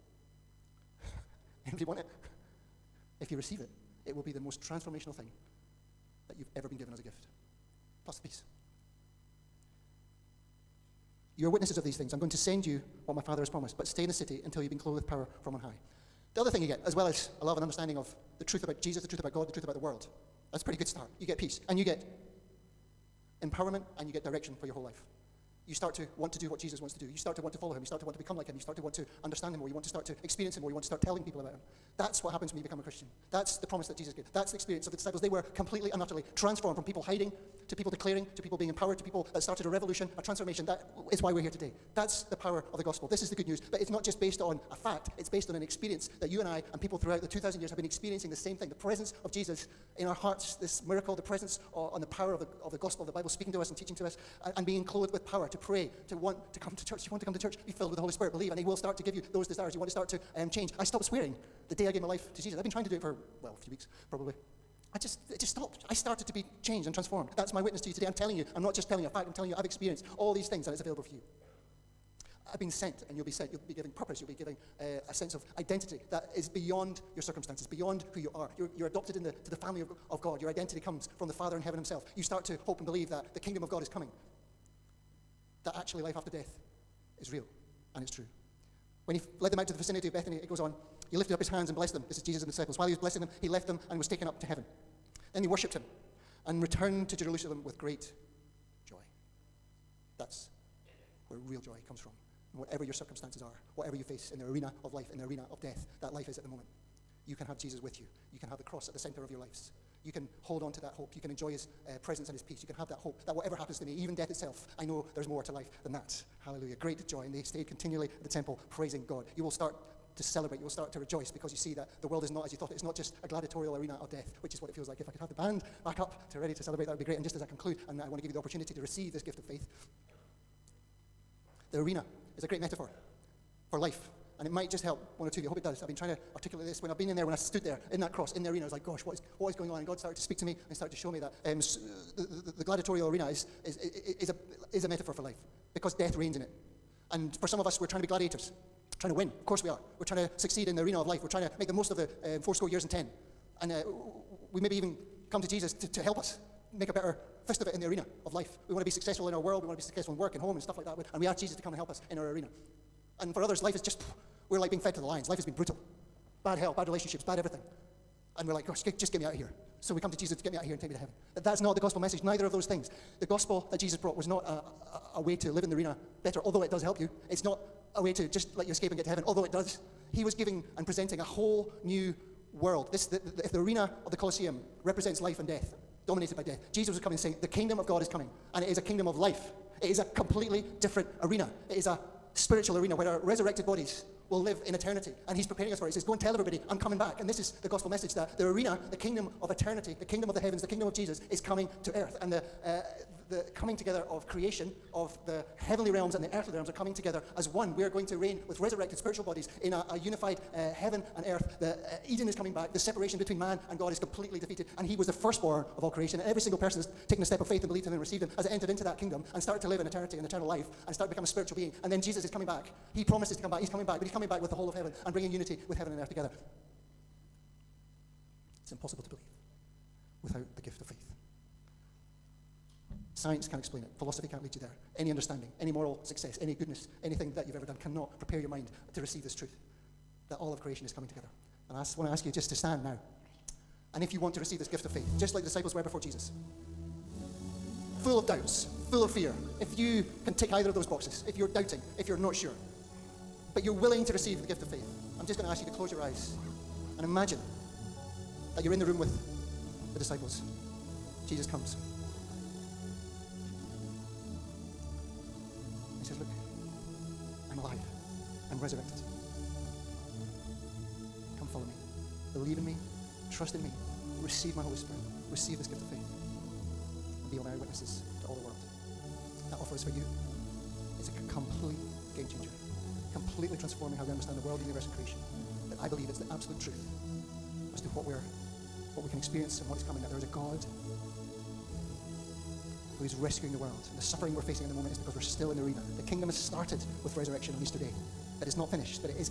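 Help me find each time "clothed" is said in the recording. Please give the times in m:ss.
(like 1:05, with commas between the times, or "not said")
0:14, 0:54.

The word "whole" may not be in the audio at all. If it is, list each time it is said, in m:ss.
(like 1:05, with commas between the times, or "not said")
0:24, 3:01, 3:44.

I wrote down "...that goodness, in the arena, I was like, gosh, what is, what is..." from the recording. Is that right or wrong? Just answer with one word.
wrong.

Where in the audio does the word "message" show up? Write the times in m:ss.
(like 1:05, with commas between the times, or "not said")
2:51, 3:17.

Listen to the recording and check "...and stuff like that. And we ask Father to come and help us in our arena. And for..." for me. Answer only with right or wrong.
wrong.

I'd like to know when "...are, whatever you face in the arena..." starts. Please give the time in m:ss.
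1:43.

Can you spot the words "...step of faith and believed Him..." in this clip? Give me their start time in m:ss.
3:37.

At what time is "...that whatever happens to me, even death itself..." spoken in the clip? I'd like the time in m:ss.
1:53.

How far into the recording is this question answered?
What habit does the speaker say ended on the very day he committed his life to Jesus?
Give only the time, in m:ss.
1:00.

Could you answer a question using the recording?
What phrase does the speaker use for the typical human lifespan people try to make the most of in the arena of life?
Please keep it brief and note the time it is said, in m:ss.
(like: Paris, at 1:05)
Four score years and ten, at 2:32.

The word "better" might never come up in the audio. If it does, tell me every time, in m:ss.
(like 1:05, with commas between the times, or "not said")
2:36, 2:56.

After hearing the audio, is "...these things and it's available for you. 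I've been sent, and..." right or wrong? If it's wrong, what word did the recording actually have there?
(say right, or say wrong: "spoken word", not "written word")
right.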